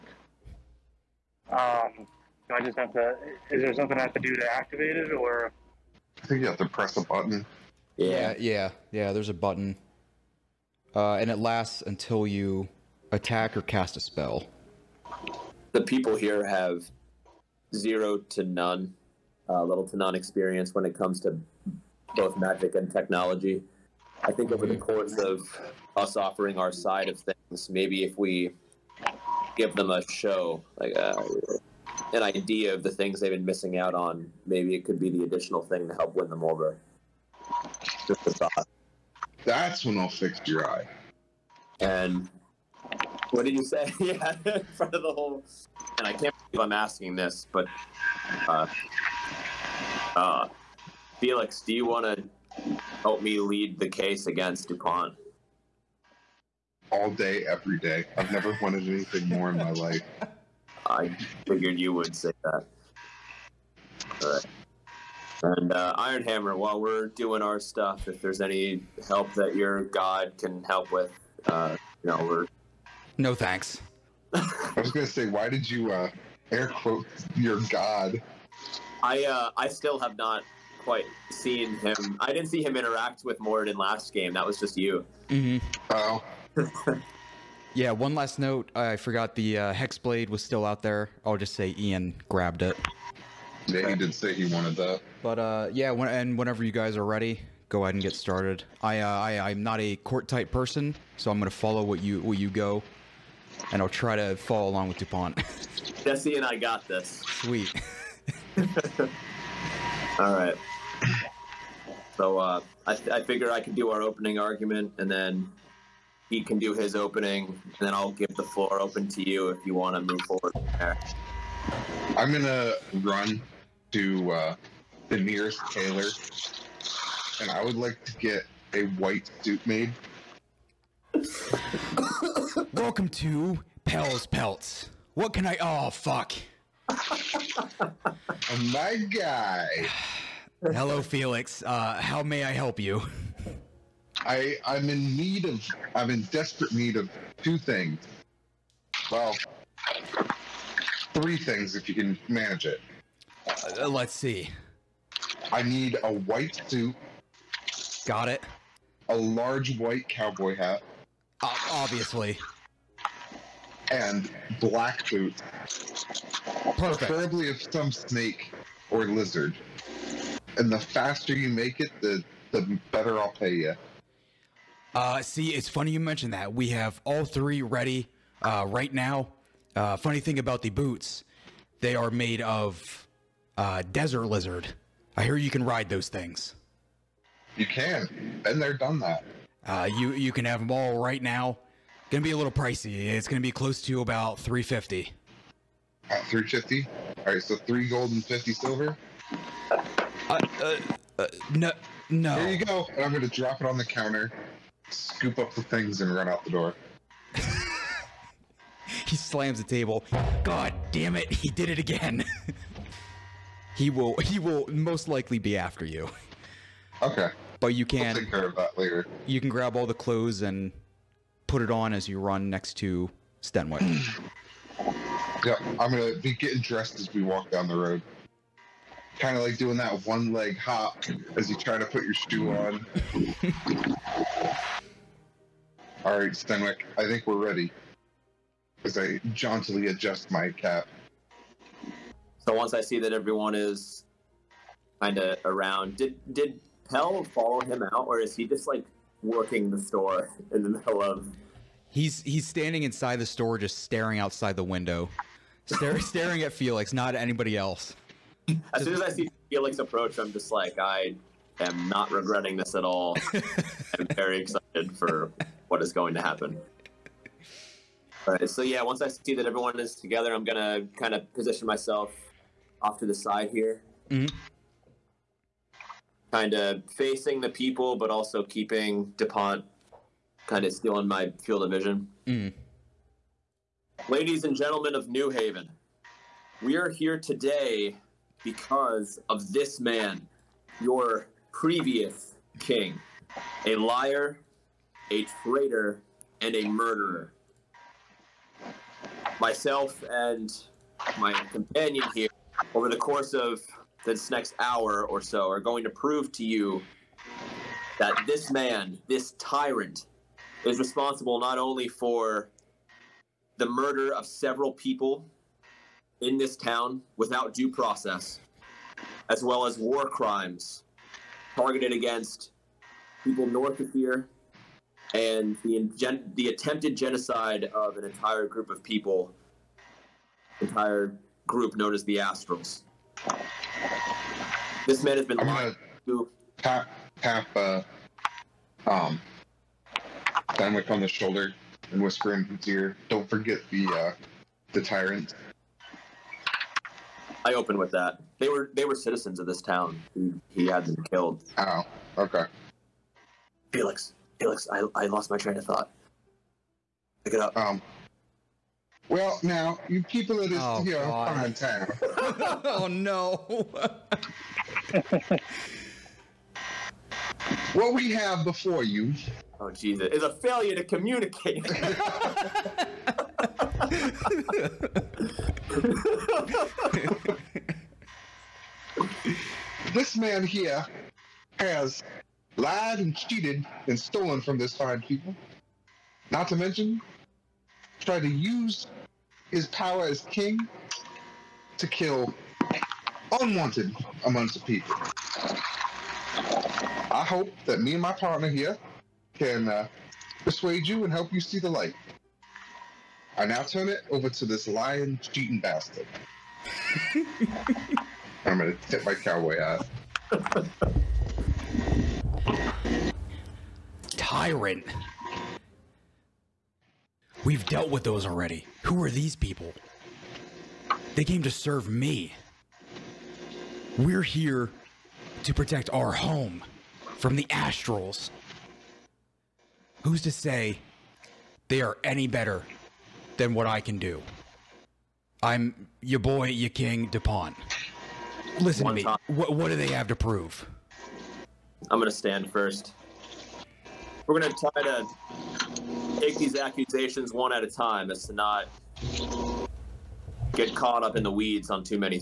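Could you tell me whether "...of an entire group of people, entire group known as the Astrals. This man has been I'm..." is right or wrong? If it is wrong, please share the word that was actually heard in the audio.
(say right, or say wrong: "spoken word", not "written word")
right.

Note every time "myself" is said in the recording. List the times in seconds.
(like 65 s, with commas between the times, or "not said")
271 s, 299 s.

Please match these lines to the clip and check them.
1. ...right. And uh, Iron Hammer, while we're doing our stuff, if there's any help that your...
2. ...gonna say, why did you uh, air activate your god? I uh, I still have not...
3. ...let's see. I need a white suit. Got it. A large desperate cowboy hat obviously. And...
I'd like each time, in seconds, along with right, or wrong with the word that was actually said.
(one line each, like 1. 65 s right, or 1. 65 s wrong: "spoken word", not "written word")
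1. 64 s right
2. 74 s wrong: "quote", not "activate"
3. 153 s wrong: "white", not "desperate".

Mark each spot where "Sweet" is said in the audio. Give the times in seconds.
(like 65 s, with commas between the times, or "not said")
107 s.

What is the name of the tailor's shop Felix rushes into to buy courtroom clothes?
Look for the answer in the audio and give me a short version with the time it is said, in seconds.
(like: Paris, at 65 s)
Pell's Pelts, at 133 s.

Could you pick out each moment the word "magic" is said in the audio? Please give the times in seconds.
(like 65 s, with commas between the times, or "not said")
22 s.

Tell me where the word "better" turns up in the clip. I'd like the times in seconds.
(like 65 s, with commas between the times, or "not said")
172 s, 432 s.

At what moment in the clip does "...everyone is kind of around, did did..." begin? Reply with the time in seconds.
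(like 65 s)
243 s.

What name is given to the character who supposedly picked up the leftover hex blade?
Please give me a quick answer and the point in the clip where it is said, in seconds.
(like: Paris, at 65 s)
Ian, at 91 s.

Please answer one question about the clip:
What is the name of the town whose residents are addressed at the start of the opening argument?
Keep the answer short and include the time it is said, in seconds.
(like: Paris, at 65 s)
New Haven, at 285 s.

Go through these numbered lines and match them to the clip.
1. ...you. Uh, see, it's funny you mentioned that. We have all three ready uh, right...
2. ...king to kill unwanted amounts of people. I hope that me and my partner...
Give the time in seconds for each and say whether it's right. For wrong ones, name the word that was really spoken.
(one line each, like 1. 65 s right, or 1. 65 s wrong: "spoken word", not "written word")
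1. 173 s right
2. 390 s right.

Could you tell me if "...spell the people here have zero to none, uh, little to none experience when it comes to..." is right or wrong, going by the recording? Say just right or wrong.
right.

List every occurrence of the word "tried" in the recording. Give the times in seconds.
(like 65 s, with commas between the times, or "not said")
387 s.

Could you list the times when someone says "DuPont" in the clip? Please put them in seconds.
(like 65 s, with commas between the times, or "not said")
54 s, 104 s, 279 s, 437 s.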